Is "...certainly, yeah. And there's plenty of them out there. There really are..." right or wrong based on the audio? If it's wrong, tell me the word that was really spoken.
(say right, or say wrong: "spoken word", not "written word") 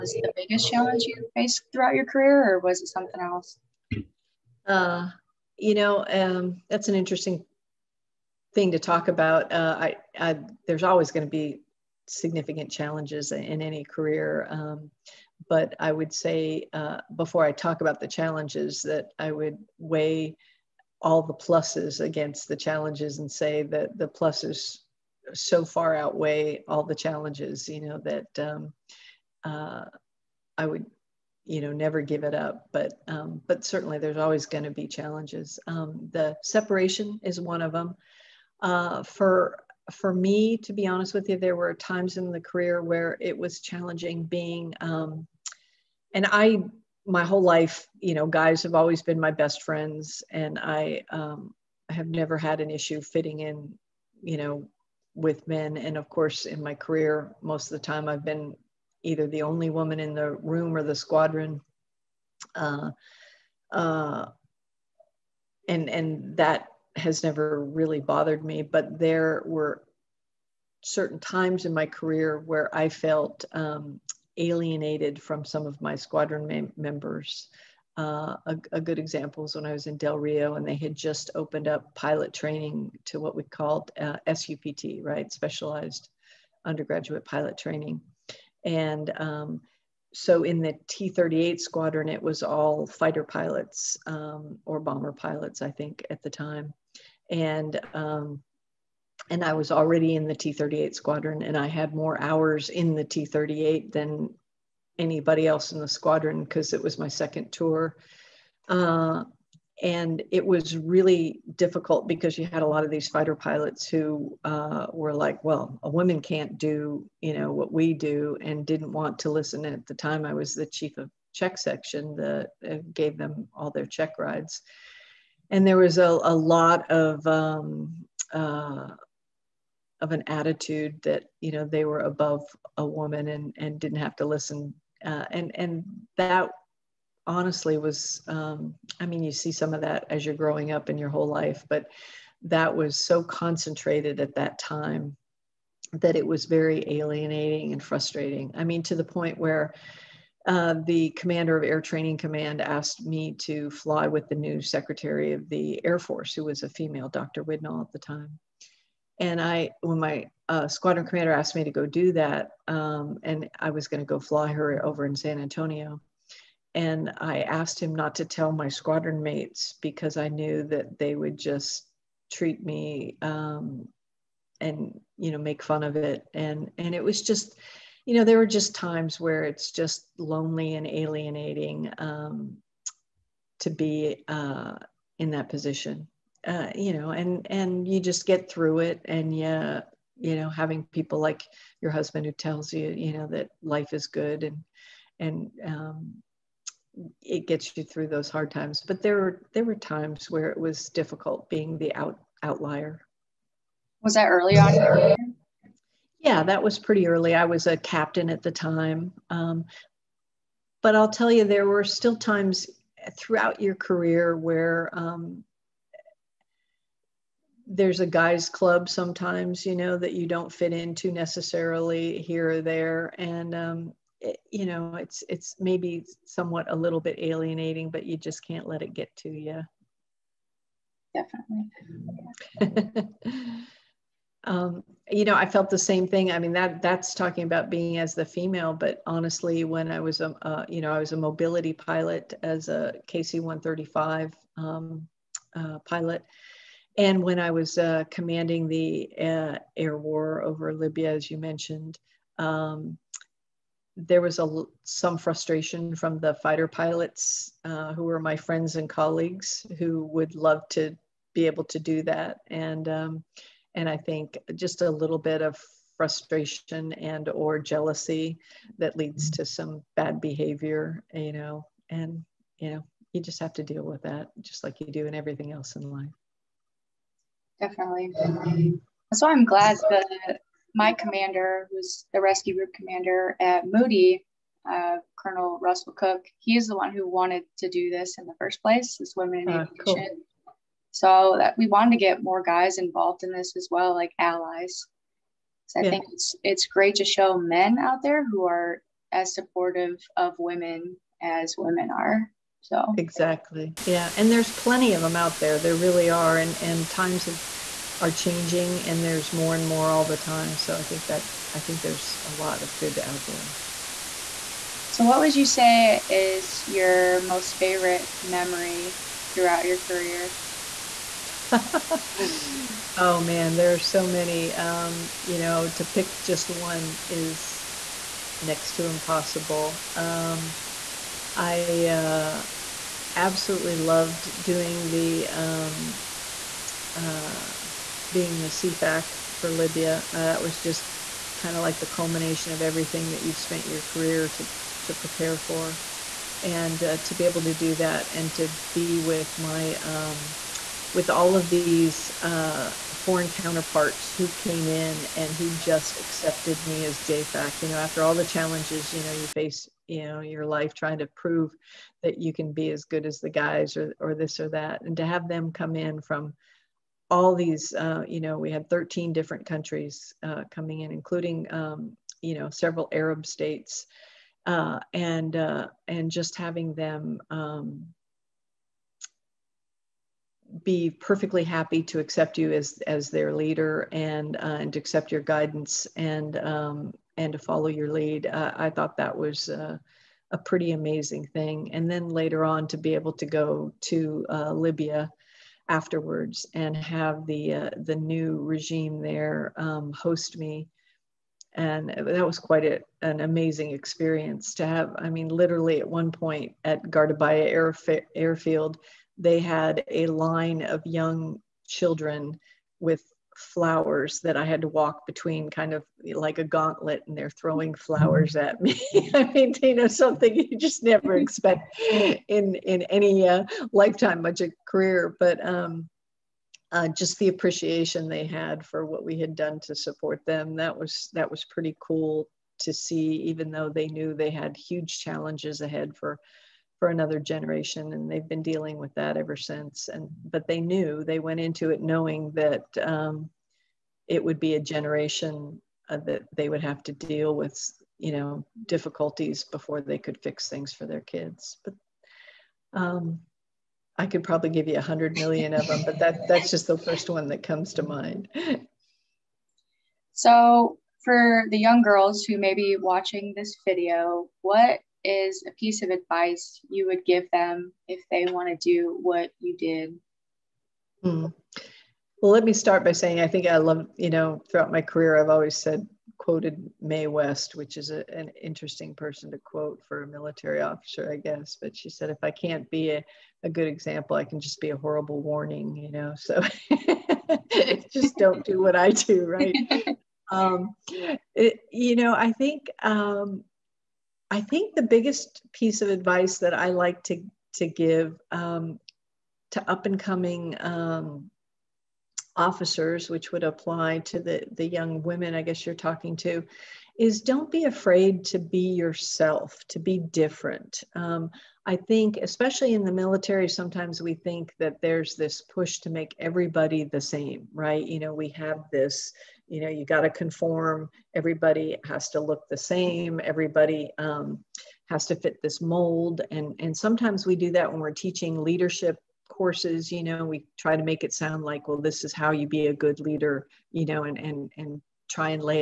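wrong: "exactly", not "certainly".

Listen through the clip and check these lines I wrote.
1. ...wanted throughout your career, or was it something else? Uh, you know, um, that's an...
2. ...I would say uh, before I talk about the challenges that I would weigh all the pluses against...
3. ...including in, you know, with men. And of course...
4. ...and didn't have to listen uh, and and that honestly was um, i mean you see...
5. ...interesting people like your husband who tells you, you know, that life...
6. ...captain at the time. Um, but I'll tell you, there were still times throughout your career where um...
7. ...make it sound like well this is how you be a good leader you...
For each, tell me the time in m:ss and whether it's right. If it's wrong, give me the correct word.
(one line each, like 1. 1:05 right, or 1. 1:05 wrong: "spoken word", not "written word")
1. 0:01 wrong: "faced", not "wanted"
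2. 0:15 right
3. 0:52 wrong: "fitting", not "including"
4. 2:13 right
5. 3:10 wrong: "having", not "interesting"
6. 3:27 right
7. 8:50 right.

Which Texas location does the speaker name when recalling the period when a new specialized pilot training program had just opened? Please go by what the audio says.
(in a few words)
Del Rio.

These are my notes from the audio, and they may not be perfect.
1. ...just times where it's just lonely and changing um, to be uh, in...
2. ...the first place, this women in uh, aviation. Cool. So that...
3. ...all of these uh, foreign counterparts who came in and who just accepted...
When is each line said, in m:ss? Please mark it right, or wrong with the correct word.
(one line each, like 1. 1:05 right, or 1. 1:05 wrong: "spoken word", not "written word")
1. 2:58 wrong: "alienating", not "changing"
2. 4:48 right
3. 5:51 right.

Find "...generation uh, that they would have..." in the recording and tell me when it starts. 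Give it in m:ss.
7:24.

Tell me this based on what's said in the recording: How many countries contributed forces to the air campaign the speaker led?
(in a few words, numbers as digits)
13.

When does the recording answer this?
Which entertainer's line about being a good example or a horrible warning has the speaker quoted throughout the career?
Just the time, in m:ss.
7:56.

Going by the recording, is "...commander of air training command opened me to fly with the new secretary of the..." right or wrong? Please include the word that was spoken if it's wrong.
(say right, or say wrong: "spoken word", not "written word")
wrong: "asked", not "opened".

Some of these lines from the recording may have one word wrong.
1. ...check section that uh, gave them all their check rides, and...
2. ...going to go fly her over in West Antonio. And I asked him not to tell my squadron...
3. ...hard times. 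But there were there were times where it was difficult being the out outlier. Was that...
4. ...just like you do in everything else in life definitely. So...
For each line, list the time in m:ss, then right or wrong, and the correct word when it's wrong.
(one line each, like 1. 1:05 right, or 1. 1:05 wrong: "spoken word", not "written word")
1. 2:01 right
2. 2:43 wrong: "San", not "West"
3. 3:18 right
4. 4:34 right.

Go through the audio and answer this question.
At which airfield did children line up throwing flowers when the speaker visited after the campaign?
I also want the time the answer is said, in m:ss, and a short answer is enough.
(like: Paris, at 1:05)
Gardabaya, at 6:46.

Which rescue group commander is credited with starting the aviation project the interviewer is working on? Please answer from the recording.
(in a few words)
Colonel Russell Cook.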